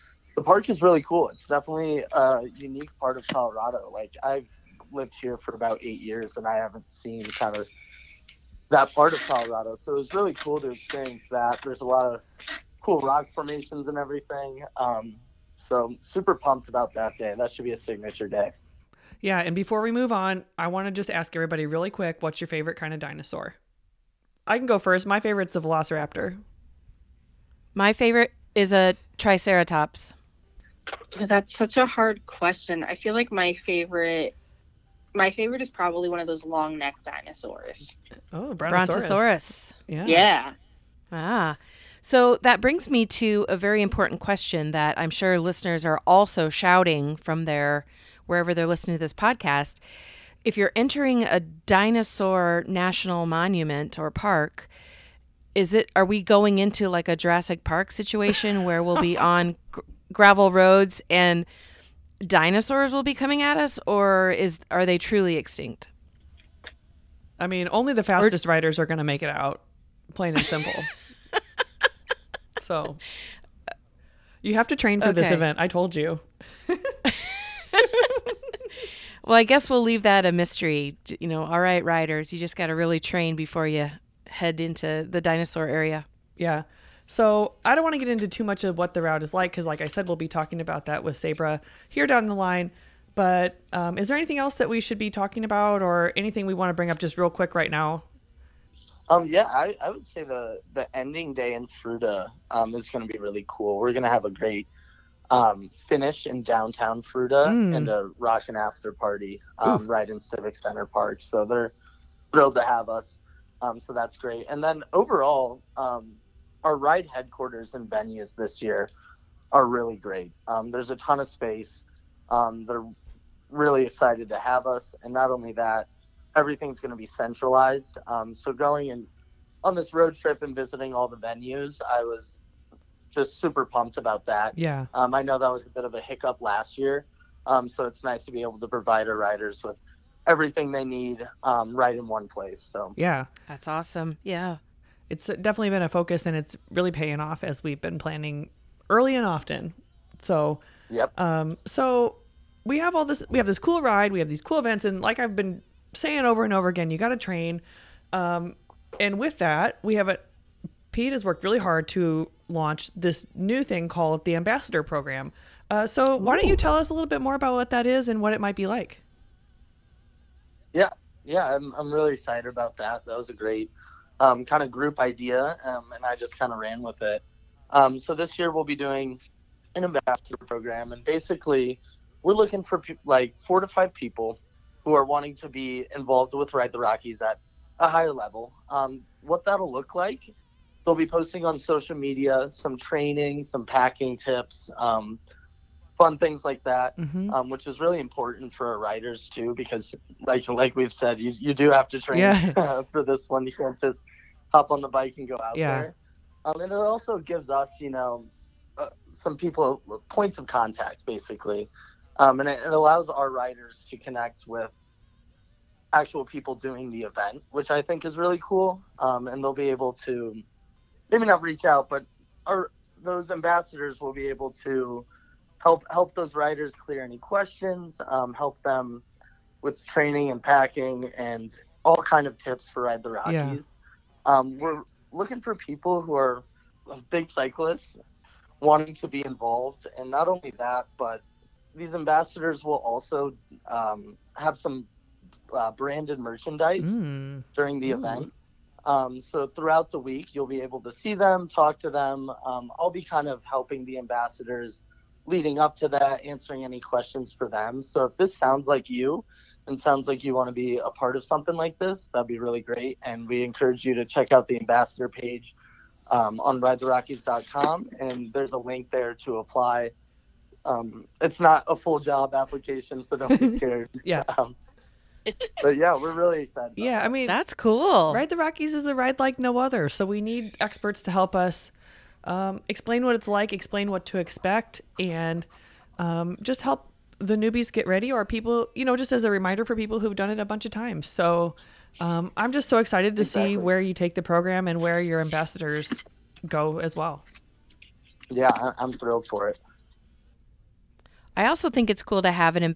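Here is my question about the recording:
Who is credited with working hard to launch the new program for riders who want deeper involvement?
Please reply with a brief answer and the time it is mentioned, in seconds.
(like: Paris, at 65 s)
Pete, at 160 s.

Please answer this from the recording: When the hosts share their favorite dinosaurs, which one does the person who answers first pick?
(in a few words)
Velociraptor.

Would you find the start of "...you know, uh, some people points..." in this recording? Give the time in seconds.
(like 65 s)
207 s.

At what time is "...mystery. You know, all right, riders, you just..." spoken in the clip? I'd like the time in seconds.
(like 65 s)
80 s.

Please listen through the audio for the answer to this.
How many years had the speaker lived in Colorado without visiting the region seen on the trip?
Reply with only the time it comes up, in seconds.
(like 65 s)
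5 s.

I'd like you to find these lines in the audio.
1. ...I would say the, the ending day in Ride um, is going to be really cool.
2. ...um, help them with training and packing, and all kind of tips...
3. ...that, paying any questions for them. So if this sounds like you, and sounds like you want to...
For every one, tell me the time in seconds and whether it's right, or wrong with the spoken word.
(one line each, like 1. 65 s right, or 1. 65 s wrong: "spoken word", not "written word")
1. 99 s wrong: "Fruita", not "Ride"
2. 228 s right
3. 255 s wrong: "answering", not "paying".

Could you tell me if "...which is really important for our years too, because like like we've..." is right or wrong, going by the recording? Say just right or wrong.
wrong.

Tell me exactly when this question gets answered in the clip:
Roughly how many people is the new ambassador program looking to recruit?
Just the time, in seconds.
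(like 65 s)
183 s.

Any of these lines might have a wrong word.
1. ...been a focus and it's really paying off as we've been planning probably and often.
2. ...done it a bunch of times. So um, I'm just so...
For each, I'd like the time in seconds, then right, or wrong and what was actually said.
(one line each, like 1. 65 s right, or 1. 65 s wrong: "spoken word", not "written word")
1. 145 s wrong: "early", not "probably"
2. 290 s right.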